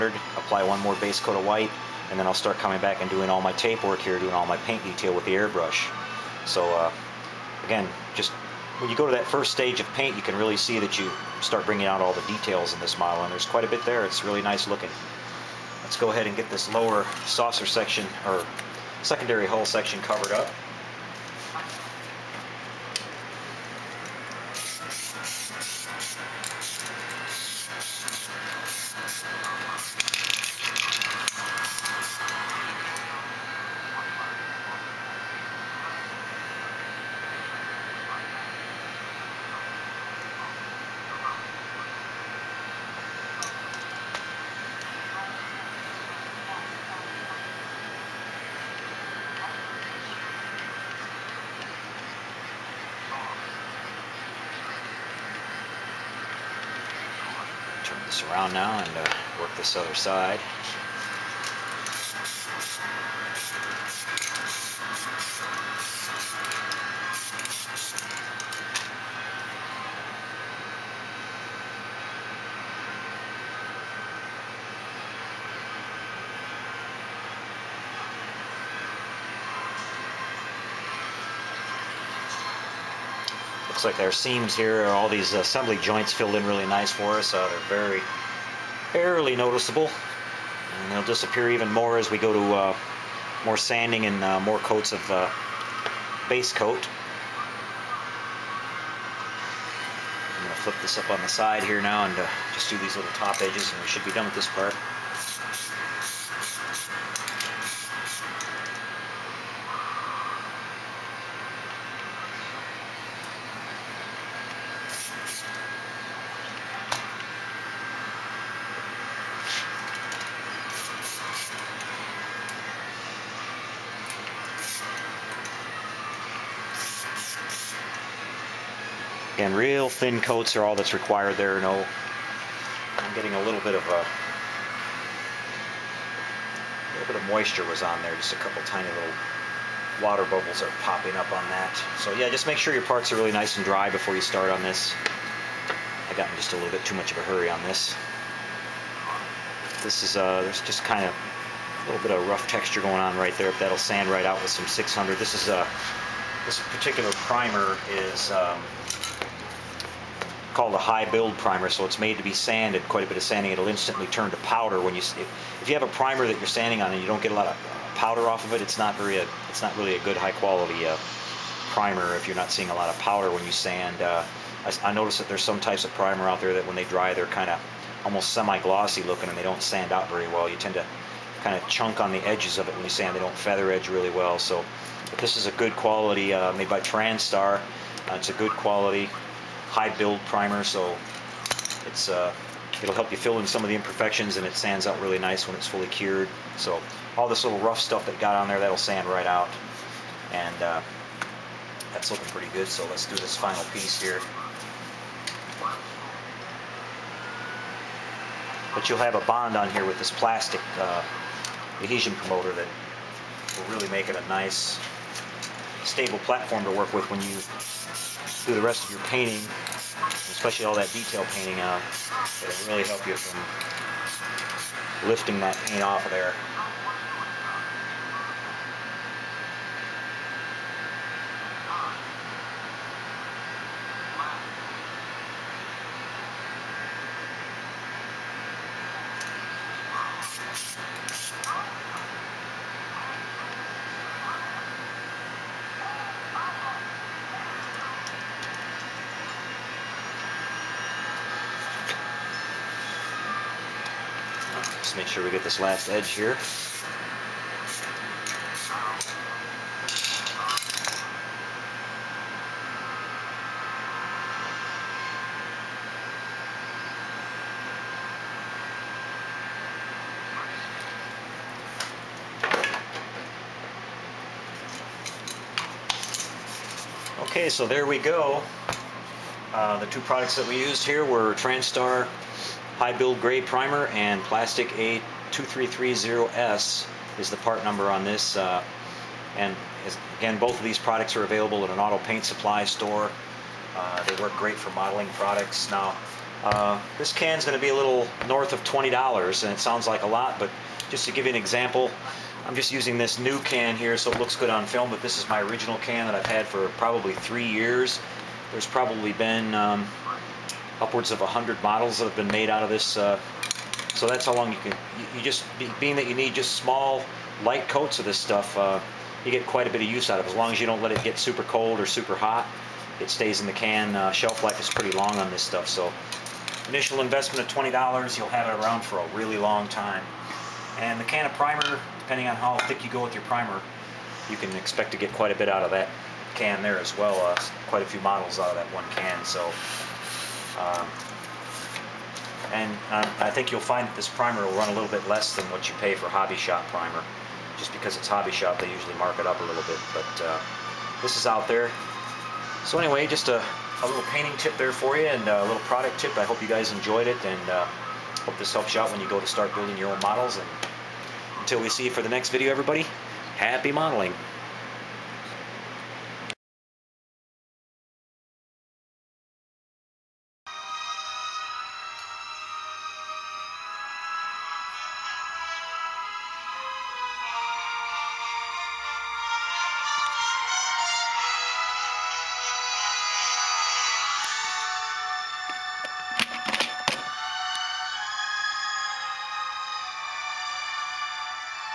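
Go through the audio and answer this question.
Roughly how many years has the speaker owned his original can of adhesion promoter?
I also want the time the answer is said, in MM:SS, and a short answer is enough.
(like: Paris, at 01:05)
3 years, at 05:07.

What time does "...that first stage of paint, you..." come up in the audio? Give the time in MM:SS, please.
00:09.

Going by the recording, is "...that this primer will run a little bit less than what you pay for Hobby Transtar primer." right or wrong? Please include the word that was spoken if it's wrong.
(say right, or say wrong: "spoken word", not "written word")
wrong: "Shop", not "Transtar".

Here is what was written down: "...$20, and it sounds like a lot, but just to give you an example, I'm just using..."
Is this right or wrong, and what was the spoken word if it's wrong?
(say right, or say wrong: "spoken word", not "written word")
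right.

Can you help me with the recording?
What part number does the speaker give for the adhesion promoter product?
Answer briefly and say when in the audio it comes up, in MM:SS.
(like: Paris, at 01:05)
A2330S, at 04:44.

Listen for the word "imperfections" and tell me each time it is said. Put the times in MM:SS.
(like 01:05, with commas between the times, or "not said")
03:13.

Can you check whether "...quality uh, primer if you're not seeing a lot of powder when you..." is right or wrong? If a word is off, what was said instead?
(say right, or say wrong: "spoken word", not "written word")
right.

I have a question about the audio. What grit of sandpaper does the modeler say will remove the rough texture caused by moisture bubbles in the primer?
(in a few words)
600.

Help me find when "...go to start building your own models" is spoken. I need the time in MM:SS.
05:59.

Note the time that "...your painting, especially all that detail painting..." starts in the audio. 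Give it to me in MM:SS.
03:38.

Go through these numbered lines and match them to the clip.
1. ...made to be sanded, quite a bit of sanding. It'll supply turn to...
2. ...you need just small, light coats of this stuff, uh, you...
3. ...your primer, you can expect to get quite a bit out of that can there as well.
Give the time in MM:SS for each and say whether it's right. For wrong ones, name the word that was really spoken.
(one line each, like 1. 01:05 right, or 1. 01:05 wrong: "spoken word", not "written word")
1. 02:42 wrong: "instantly", not "supply"
2. 05:16 right
3. 05:33 right.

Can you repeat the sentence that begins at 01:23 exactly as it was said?
looks like our seams here, all these assembly joints filled in really nice for us.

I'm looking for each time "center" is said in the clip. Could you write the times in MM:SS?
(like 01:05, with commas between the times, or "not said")
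not said.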